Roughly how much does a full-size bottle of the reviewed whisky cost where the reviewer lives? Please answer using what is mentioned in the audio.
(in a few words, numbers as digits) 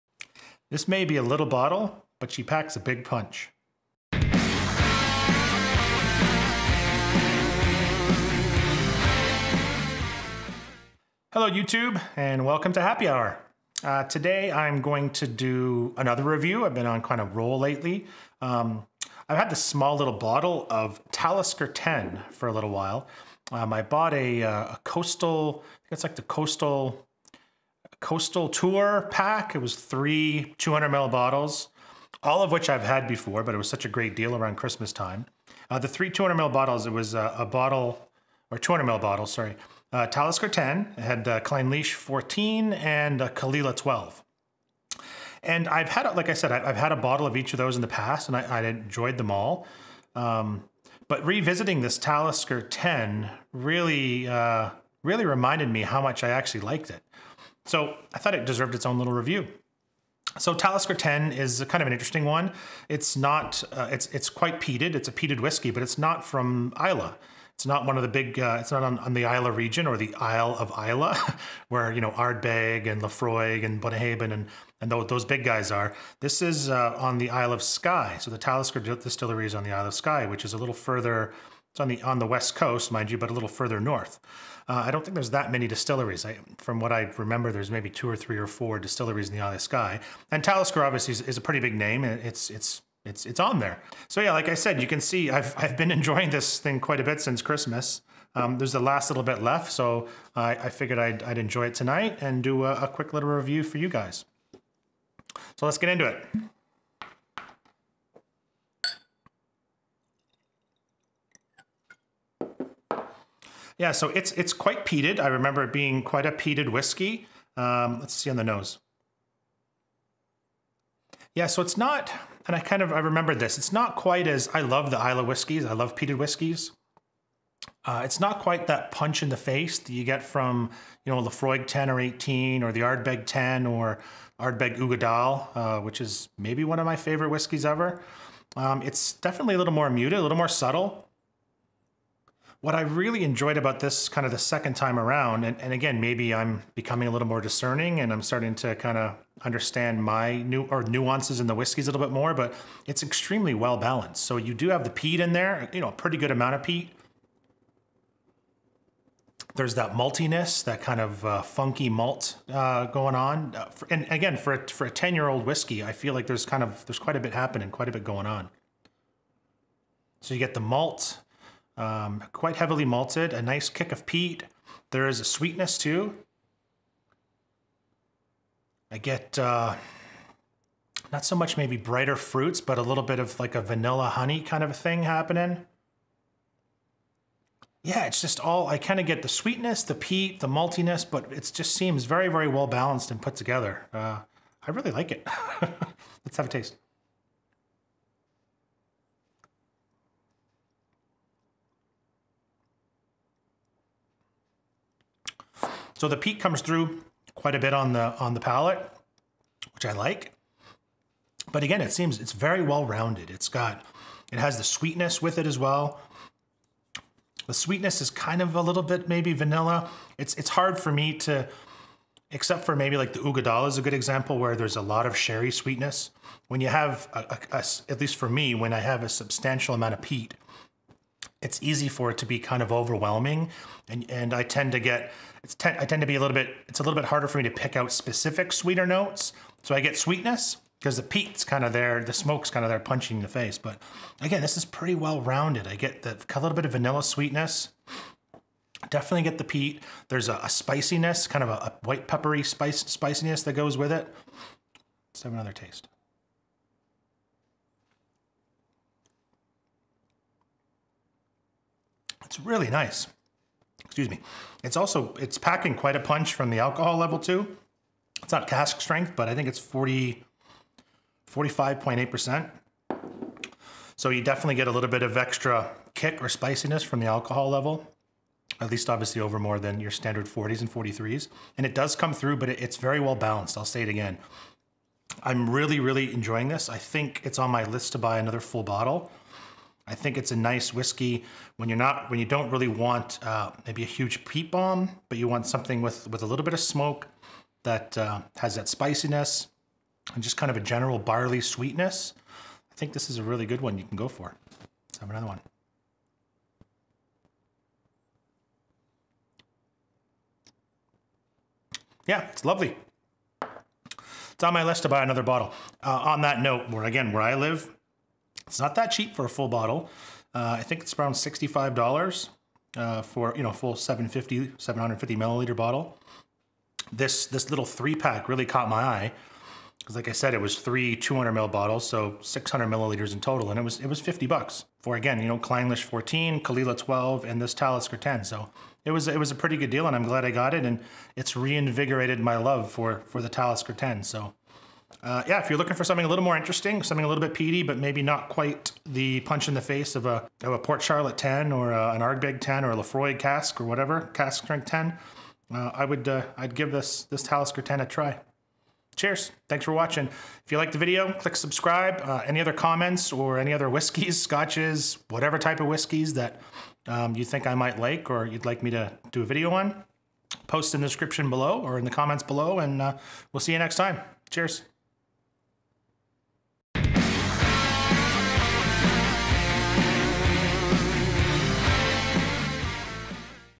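$65.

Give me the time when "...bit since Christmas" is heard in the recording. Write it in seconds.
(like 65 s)
97 s.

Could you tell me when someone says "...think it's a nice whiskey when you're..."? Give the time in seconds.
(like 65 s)
289 s.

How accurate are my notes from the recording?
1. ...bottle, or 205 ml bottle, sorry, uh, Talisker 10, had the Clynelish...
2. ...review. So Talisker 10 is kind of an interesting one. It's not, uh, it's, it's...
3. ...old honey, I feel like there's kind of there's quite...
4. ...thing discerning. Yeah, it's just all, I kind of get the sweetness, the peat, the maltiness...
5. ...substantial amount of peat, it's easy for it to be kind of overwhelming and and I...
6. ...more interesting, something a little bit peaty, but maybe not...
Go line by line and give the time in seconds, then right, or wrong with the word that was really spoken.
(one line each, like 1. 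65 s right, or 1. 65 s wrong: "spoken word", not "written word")
1. 37 s wrong: "200", not "205"
2. 59 s right
3. 165 s wrong: "whiskey", not "honey"
4. 184 s wrong: "happening", not "discerning"
5. 229 s right
6. 346 s right.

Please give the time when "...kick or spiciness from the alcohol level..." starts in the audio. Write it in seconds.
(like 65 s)
275 s.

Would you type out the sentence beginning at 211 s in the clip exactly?
But again, it seems it's very well rounded.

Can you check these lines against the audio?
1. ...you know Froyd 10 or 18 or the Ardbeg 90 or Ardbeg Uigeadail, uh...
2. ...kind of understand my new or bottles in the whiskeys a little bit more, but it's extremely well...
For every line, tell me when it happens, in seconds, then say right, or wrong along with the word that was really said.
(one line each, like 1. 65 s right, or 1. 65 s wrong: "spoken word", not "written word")
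1. 131 s wrong: "10", not "90"
2. 148 s wrong: "nuances", not "bottles".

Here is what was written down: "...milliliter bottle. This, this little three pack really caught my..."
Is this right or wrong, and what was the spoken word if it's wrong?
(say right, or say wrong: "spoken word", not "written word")
right.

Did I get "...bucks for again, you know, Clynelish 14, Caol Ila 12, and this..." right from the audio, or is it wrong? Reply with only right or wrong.
right.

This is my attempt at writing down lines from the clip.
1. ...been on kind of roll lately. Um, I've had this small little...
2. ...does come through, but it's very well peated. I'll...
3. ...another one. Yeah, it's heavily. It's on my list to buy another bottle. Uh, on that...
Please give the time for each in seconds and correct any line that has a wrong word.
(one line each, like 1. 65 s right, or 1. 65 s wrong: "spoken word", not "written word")
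1. 16 s right
2. 281 s wrong: "balanced", not "peated"
3. 305 s wrong: "lovely", not "heavily".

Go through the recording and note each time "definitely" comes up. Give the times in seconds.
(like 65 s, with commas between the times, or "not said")
139 s, 248 s, 274 s.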